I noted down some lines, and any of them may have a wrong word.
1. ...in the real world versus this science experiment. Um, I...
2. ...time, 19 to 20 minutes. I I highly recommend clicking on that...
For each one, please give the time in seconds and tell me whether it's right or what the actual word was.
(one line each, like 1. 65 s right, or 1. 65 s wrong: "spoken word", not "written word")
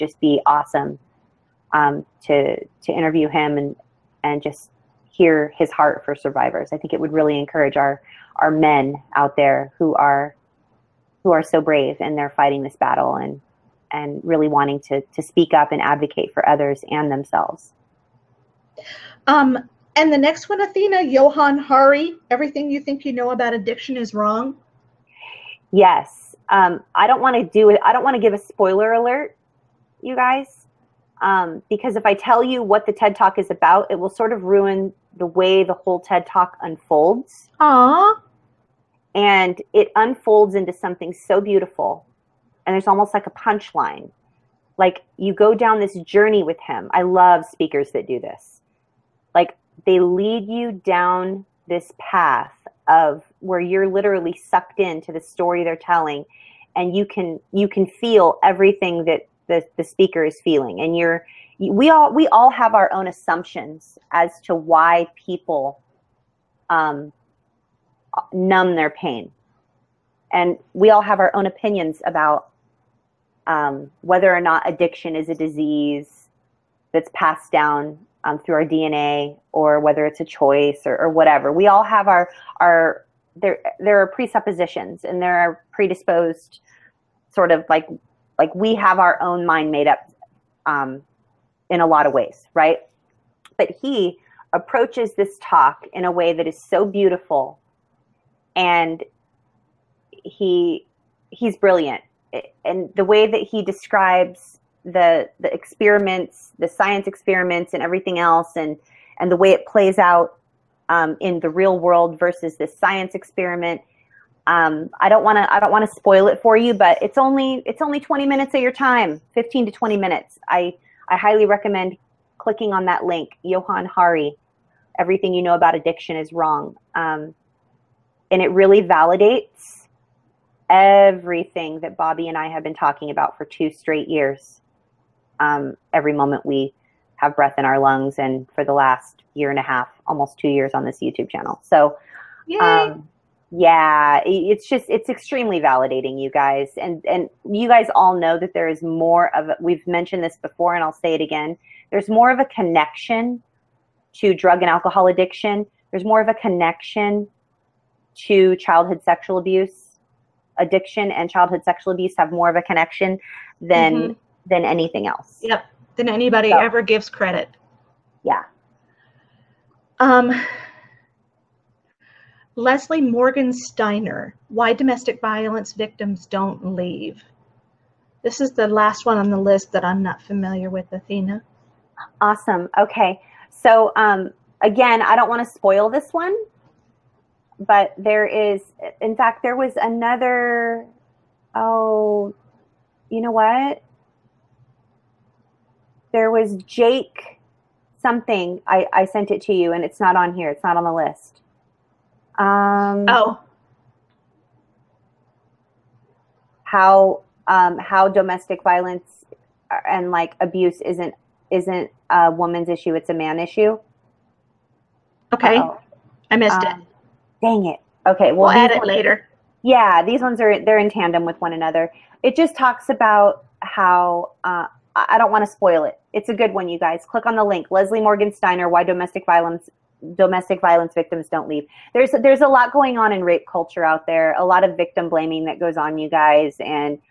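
1. 111 s right
2. 118 s wrong: "15", not "19".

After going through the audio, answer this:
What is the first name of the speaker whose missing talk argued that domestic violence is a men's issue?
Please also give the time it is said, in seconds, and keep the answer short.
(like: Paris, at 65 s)
Jake, at 196 s.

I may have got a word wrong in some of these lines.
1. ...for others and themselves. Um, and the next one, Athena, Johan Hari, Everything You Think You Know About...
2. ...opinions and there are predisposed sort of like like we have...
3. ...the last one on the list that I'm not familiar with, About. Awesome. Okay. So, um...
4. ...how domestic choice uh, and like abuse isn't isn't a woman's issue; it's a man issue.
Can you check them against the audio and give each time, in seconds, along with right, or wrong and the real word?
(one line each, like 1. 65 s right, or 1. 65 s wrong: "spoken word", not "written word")
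1. 16 s right
2. 84 s wrong: "presuppositions", not "opinions"
3. 178 s wrong: "Athena", not "About"
4. 207 s wrong: "violence", not "choice".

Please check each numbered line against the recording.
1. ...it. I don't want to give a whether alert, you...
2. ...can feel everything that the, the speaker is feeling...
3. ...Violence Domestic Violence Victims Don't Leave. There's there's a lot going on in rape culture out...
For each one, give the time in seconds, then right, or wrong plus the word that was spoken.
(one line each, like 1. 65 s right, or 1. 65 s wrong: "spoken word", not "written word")
1. 27 s wrong: "spoiler", not "whether"
2. 57 s right
3. 229 s right.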